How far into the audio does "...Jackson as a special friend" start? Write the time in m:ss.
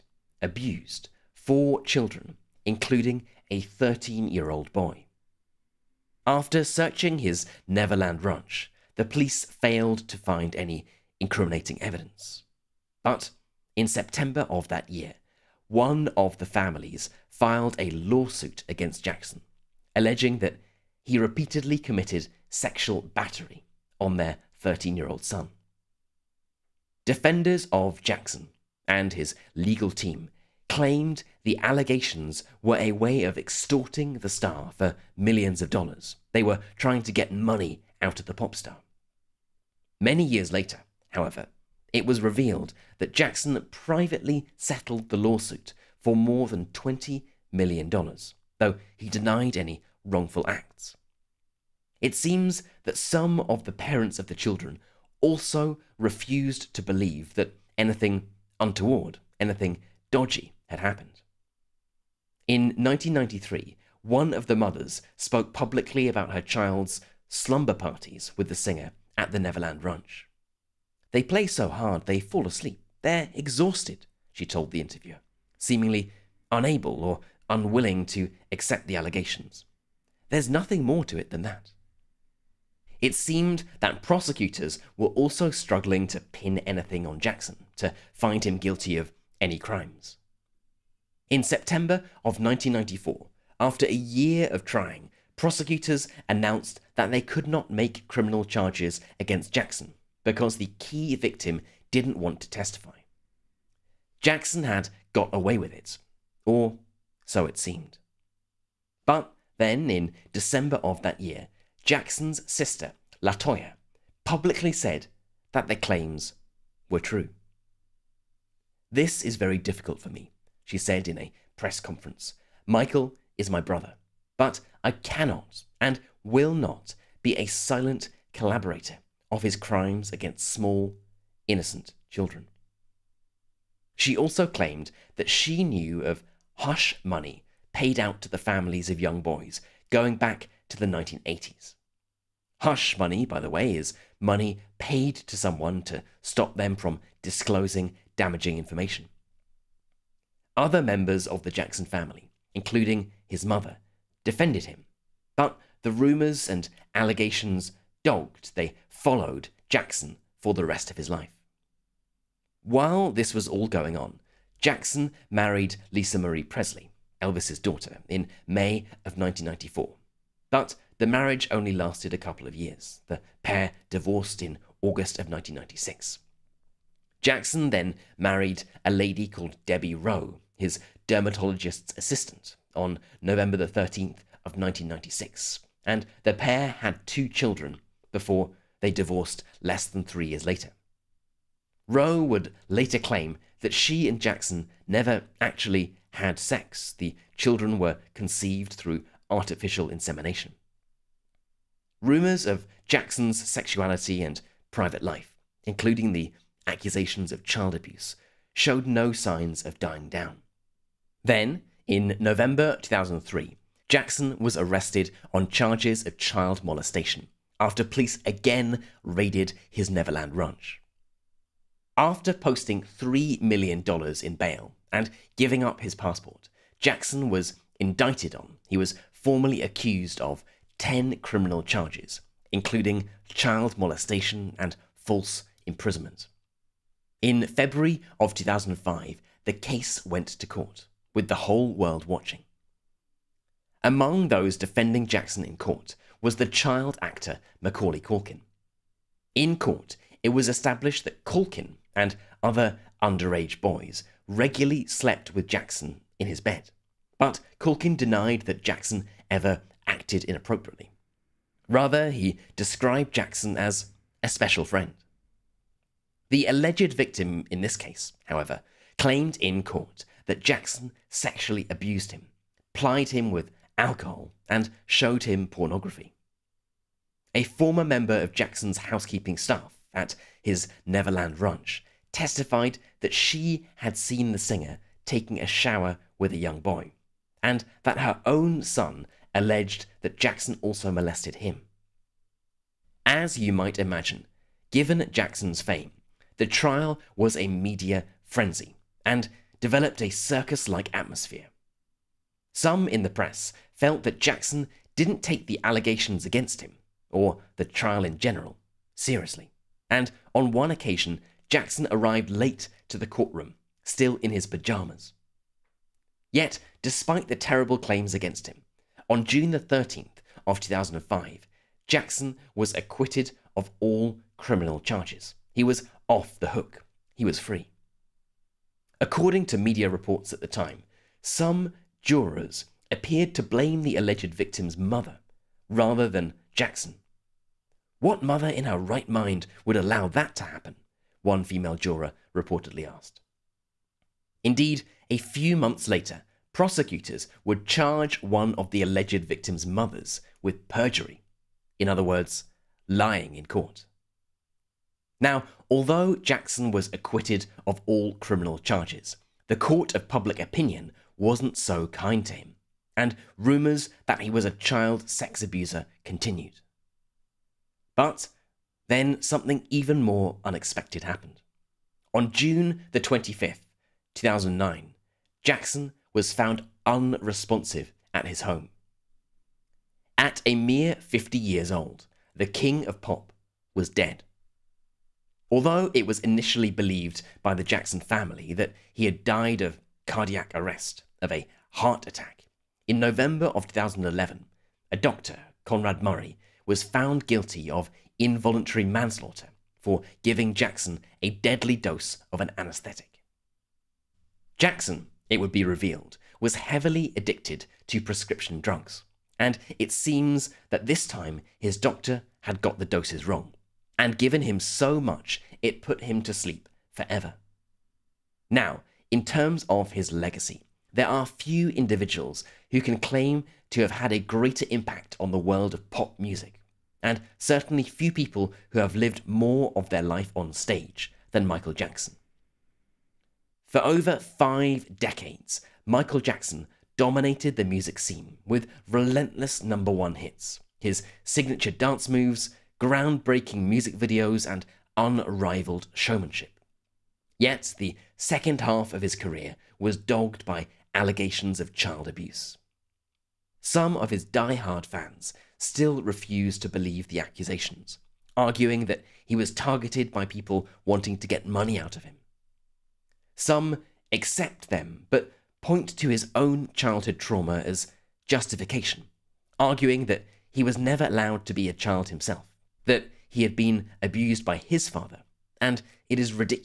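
4:23.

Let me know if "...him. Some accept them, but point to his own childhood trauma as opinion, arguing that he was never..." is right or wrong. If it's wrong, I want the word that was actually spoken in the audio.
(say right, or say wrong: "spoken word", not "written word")
wrong: "justification", not "opinion".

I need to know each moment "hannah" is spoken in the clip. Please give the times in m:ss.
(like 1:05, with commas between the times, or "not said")
not said.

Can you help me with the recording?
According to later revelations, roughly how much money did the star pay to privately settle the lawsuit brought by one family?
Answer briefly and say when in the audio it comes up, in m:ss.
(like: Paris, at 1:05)
more than $20 million, at 0:46.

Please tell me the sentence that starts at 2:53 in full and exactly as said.
The pair divorced in August of 1996.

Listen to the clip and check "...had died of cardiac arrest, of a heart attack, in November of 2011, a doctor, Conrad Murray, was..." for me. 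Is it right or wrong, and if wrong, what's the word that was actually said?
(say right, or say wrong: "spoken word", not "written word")
right.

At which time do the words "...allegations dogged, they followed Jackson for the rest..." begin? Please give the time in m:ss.
2:36.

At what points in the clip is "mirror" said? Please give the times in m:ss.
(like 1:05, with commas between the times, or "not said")
not said.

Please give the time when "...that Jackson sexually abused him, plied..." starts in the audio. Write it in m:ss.
4:30.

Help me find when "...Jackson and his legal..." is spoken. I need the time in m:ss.
0:28.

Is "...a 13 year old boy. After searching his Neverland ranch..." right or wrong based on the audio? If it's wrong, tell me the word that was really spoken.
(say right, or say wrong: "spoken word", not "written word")
right.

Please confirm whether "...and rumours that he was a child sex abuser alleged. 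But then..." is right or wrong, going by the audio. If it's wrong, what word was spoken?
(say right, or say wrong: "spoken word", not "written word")
wrong: "continued", not "alleged".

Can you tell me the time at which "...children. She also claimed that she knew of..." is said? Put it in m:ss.
2:12.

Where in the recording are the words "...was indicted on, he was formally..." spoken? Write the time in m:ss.
3:47.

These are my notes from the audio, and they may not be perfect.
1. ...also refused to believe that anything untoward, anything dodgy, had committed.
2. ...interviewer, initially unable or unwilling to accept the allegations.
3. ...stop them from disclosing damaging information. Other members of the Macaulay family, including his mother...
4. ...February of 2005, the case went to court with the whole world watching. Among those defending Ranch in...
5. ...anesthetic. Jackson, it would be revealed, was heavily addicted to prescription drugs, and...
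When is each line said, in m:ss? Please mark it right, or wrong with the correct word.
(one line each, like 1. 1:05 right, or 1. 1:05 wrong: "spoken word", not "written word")
1. 0:55 wrong: "happened", not "committed"
2. 1:14 wrong: "seemingly", not "initially"
3. 2:26 wrong: "Jackson", not "Macaulay"
4. 3:57 wrong: "Jackson", not "Ranch"
5. 6:42 right.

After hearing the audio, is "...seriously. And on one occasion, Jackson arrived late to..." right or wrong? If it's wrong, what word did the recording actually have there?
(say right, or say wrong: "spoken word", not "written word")
right.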